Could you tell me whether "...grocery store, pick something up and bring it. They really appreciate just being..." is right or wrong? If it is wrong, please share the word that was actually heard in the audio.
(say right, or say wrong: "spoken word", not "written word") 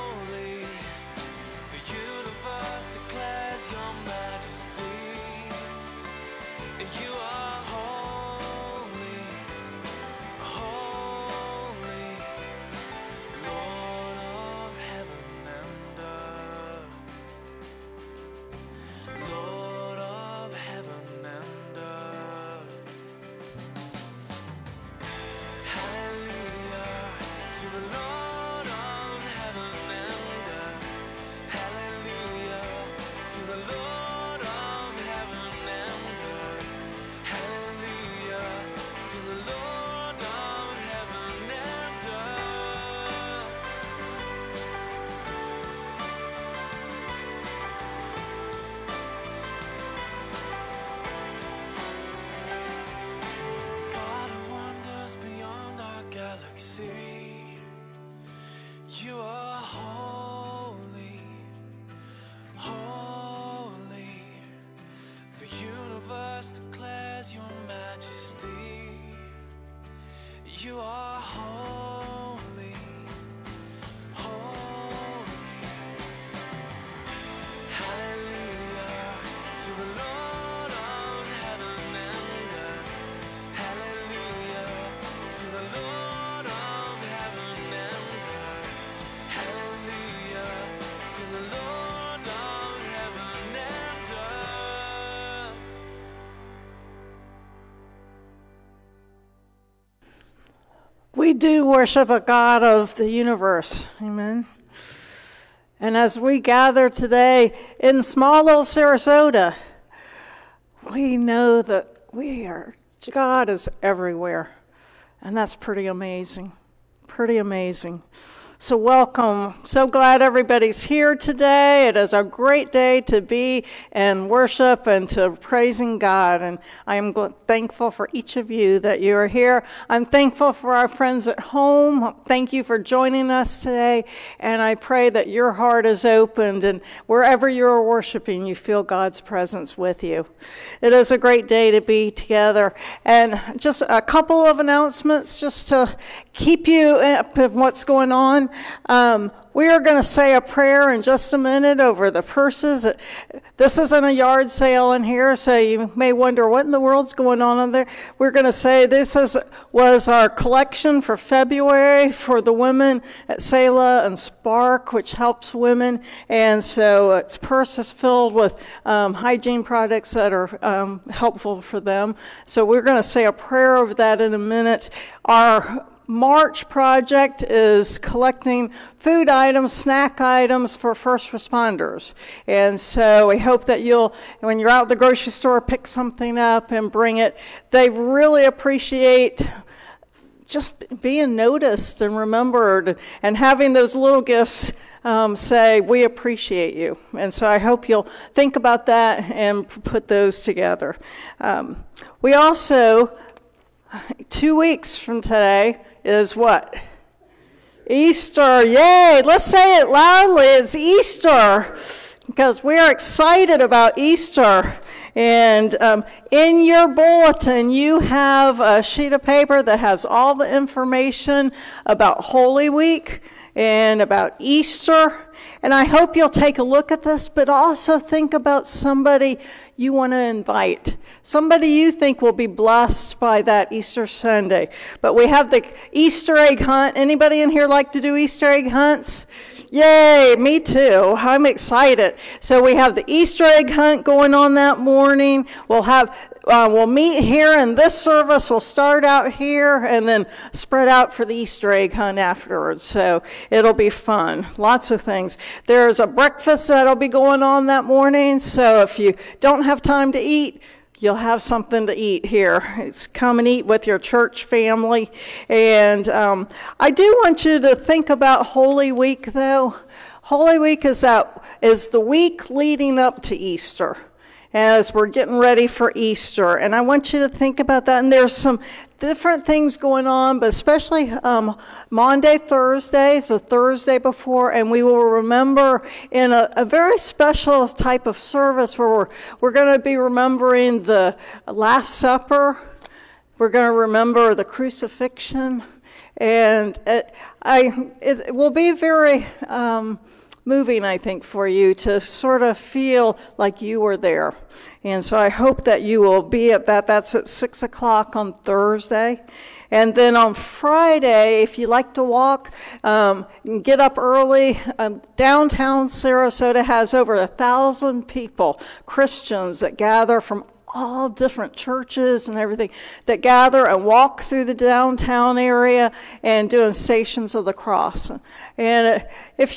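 right.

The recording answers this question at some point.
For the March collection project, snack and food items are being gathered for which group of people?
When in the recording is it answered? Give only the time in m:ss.
3:00.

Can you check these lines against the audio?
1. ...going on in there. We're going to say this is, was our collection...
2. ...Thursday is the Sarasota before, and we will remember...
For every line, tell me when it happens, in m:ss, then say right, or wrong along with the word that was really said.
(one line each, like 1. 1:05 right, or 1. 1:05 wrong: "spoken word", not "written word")
1. 2:37 right
2. 4:42 wrong: "Thursday", not "Sarasota".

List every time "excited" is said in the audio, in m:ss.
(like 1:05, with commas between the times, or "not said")
3:32, 4:01.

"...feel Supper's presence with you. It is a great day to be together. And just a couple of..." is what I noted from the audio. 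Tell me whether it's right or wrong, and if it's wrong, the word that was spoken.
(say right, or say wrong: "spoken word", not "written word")
wrong: "God", not "Supper".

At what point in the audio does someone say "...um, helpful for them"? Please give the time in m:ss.
2:50.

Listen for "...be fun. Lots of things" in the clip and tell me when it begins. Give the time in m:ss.
4:13.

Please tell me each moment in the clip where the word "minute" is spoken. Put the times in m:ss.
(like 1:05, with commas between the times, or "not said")
2:31, 2:54.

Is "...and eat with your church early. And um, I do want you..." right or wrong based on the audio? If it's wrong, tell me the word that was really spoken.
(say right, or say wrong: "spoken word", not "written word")
wrong: "family", not "early".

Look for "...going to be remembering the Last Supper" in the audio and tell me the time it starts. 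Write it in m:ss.
4:49.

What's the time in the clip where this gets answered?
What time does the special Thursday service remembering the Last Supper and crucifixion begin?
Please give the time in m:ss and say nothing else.
5:07.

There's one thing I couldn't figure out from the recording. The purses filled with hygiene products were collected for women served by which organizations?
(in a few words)
Selah and Spark.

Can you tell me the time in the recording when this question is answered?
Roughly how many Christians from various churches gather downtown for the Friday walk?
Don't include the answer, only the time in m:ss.
5:16.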